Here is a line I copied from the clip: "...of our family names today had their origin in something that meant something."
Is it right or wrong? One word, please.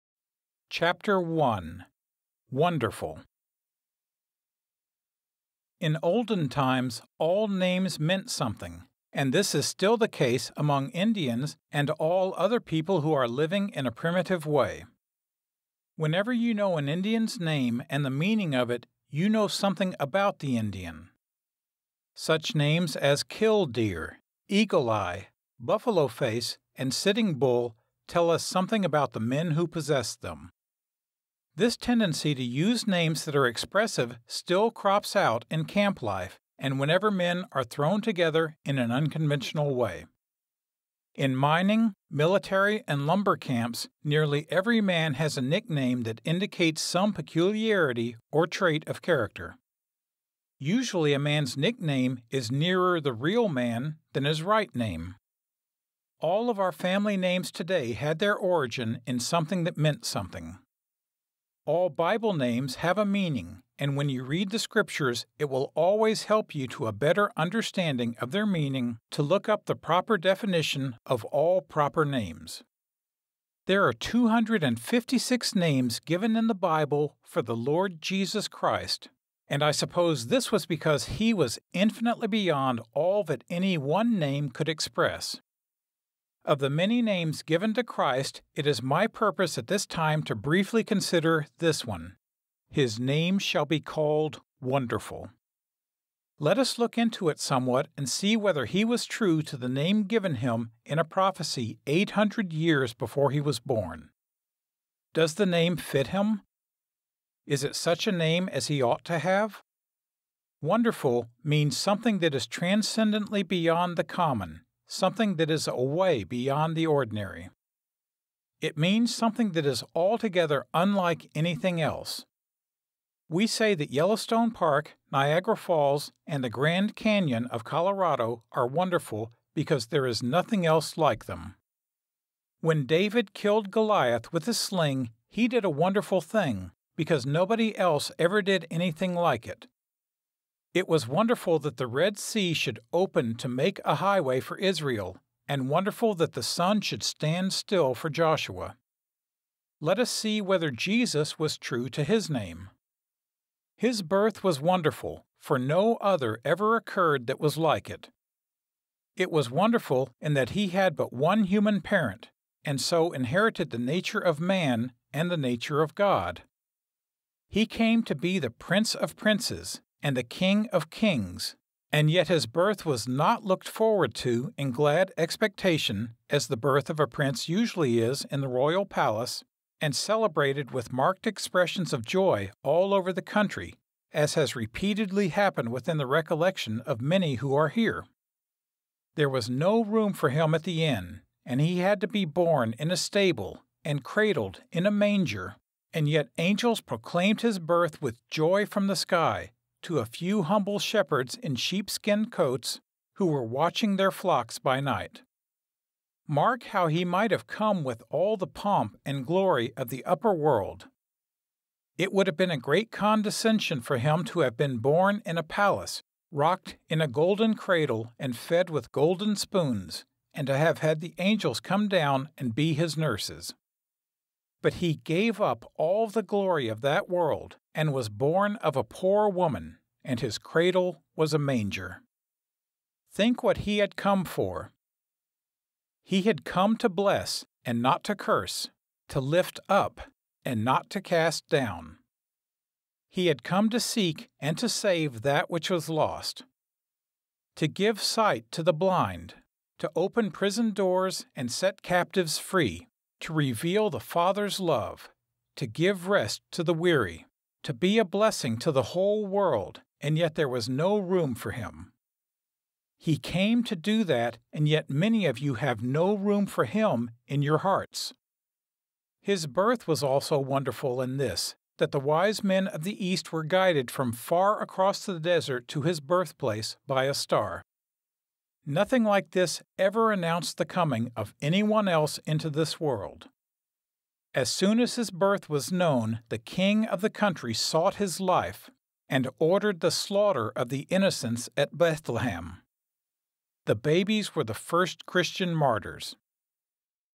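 right.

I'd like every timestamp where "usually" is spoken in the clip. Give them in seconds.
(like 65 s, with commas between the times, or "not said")
50 s, 177 s.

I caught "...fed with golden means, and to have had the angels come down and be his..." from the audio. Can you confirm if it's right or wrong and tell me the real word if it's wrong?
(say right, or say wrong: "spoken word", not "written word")
wrong: "spoons", not "means".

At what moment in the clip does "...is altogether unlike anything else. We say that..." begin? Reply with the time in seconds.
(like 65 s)
119 s.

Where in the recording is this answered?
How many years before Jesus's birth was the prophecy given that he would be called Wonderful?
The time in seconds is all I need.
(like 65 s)
101 s.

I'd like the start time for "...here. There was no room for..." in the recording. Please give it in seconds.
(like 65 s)
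187 s.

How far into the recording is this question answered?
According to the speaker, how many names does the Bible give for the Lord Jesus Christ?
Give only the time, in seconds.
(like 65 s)
73 s.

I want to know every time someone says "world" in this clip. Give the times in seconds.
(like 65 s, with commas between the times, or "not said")
210 s, 227 s, 259 s, 282 s.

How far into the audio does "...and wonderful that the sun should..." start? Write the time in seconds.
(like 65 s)
145 s.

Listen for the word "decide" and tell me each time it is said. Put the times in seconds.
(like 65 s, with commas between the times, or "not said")
not said.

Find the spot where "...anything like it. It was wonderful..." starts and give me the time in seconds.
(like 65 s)
138 s.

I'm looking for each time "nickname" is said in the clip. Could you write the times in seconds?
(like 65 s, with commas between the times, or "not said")
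45 s, 51 s.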